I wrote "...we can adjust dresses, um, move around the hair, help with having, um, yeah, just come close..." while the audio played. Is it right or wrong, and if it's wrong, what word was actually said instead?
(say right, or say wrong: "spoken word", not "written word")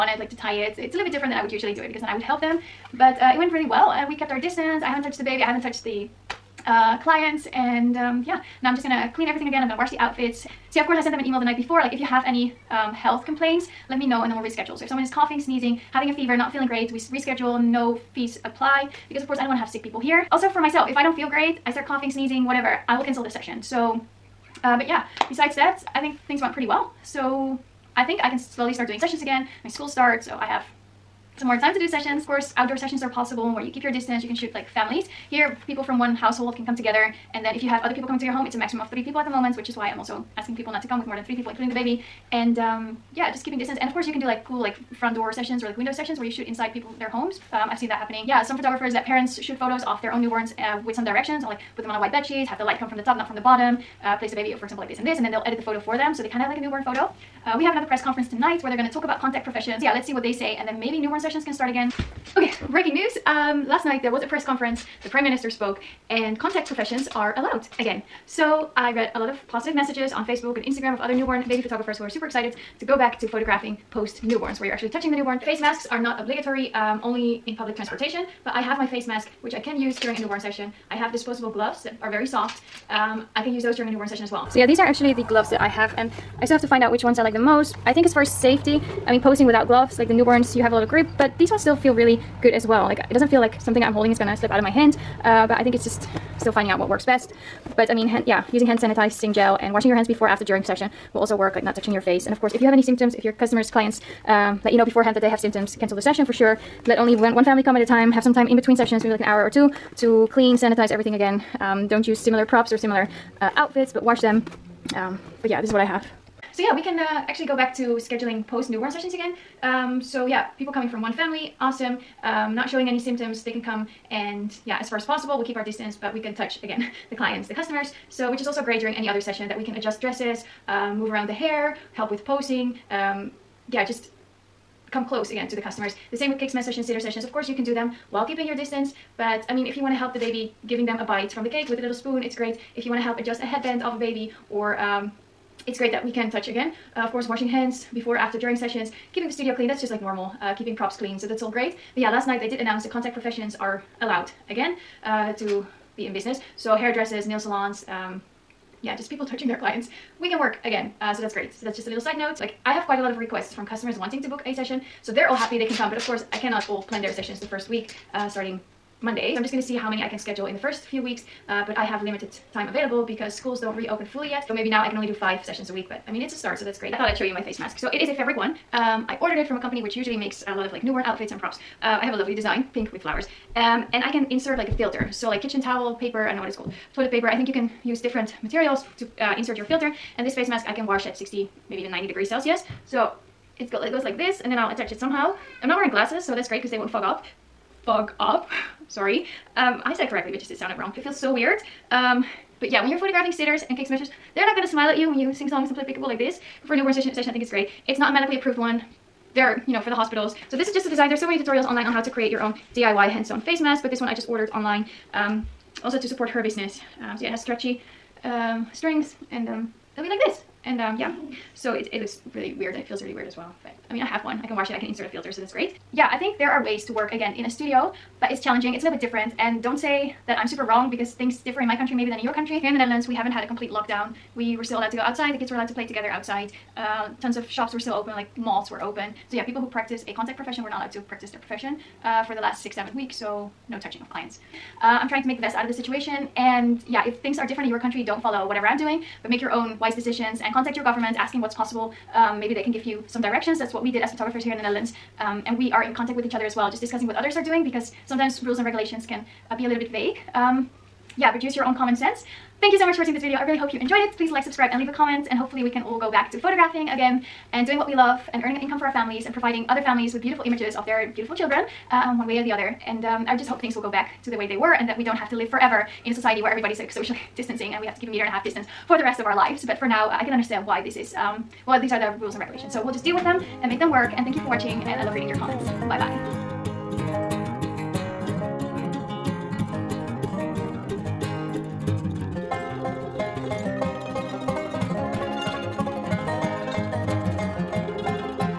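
wrong: "posing", not "having".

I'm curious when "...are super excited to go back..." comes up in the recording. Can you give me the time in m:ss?
1:12.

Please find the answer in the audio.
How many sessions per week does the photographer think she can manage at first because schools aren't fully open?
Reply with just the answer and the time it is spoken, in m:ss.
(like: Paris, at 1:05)
5, at 2:55.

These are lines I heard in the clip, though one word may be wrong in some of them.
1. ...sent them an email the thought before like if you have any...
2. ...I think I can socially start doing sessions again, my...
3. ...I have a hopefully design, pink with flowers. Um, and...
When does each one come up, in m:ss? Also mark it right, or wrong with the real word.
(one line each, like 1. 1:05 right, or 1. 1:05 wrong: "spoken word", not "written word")
1. 0:11 wrong: "night", not "thought"
2. 0:27 wrong: "slowly", not "socially"
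3. 3:02 wrong: "lovely", not "hopefully".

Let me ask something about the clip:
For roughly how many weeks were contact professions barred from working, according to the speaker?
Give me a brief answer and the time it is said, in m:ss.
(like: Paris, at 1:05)
6 or 7 weeks, at 4:02.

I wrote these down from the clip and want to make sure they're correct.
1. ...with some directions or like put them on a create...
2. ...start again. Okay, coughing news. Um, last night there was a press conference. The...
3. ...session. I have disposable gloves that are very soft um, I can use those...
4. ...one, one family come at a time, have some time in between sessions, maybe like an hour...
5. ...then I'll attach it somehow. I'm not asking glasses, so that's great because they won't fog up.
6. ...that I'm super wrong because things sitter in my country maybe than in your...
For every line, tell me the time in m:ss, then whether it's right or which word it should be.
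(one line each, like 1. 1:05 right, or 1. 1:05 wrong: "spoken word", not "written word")
1. 0:50 wrong: "white", not "create"
2. 1:01 wrong: "breaking", not "coughing"
3. 1:20 right
4. 1:47 right
5. 3:14 wrong: "wearing", not "asking"
6. 3:50 wrong: "differ", not "sitter".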